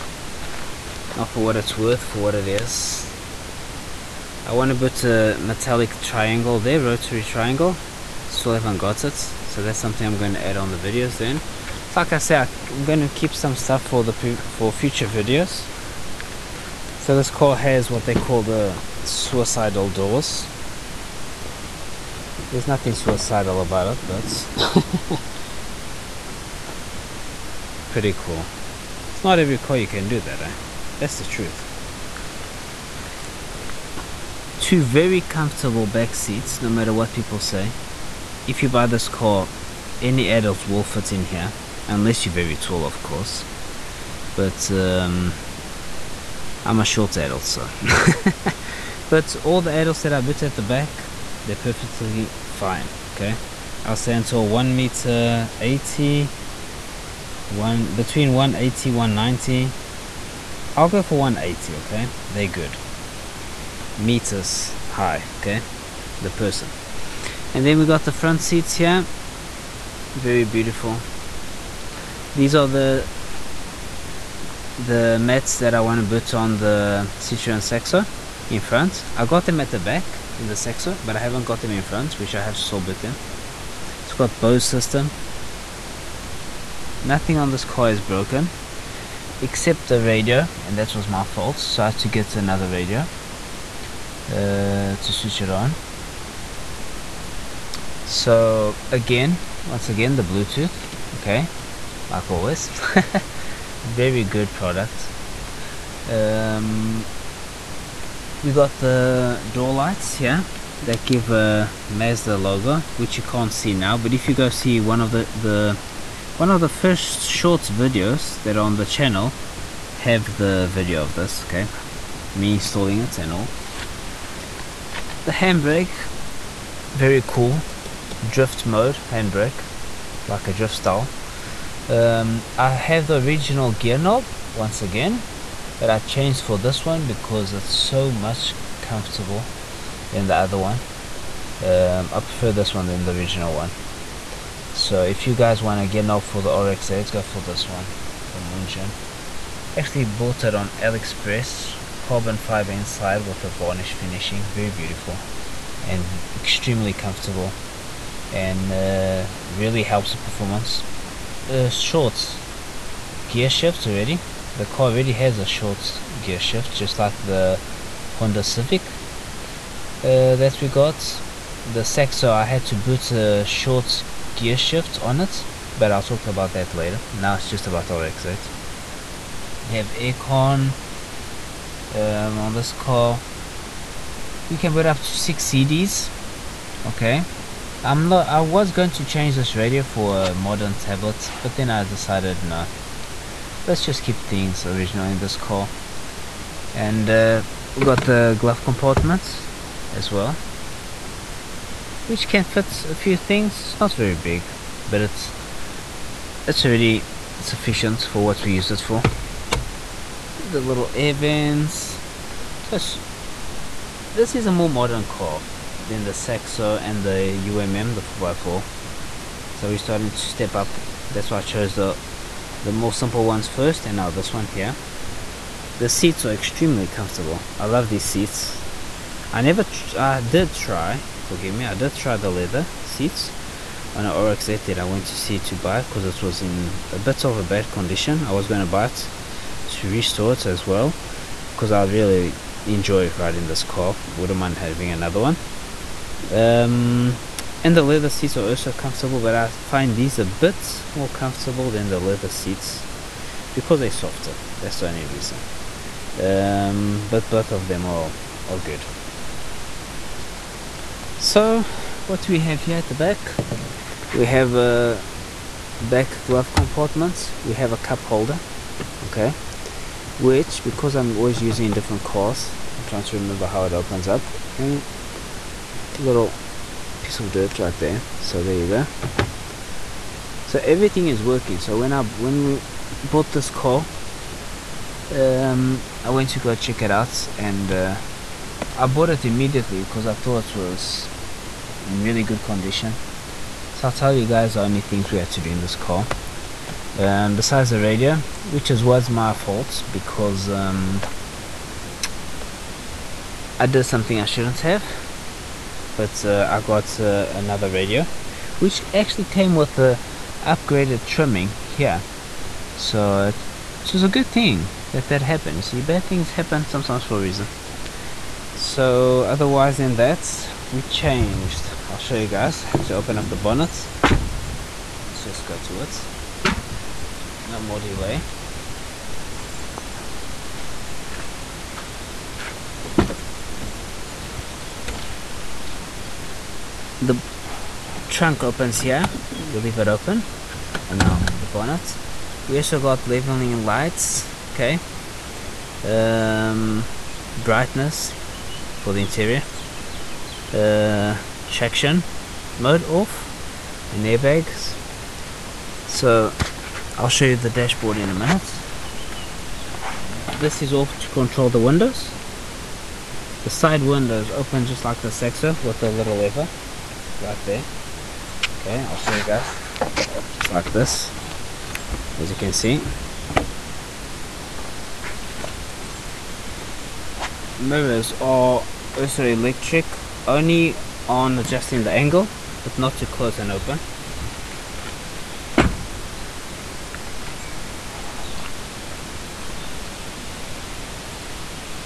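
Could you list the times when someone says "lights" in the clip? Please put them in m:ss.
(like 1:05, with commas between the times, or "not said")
1:49, 5:43.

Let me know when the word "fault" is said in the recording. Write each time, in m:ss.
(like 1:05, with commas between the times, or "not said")
1:31, 4:59.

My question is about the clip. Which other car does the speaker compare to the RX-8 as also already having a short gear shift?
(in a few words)
Honda Civic.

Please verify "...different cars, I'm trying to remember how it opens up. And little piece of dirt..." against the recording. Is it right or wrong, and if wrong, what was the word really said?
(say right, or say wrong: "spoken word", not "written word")
right.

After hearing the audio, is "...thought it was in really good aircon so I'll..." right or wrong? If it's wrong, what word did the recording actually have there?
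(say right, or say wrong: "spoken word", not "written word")
wrong: "condition", not "aircon".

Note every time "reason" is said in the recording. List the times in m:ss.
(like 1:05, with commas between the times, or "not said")
4:15, 5:17.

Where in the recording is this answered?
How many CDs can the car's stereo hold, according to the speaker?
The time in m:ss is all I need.
3:05.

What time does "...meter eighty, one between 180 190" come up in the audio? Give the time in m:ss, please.
0:54.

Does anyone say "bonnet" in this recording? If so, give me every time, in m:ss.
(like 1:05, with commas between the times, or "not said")
5:23, 5:41.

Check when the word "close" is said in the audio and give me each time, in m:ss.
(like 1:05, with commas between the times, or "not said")
6:23.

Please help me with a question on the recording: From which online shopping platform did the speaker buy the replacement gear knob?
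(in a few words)
AliExpress.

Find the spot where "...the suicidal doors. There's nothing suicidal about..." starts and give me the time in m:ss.
0:18.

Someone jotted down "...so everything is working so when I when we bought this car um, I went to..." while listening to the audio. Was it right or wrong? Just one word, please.
right.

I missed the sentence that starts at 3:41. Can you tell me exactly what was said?
That's why I chose the, the more simple ones first and now this one here.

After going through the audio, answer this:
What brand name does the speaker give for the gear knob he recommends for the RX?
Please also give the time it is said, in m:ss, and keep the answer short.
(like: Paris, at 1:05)
Munjin, at 2:28.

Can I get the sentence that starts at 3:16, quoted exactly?
And uh, we got the glove compartment as well, which can fit a few things.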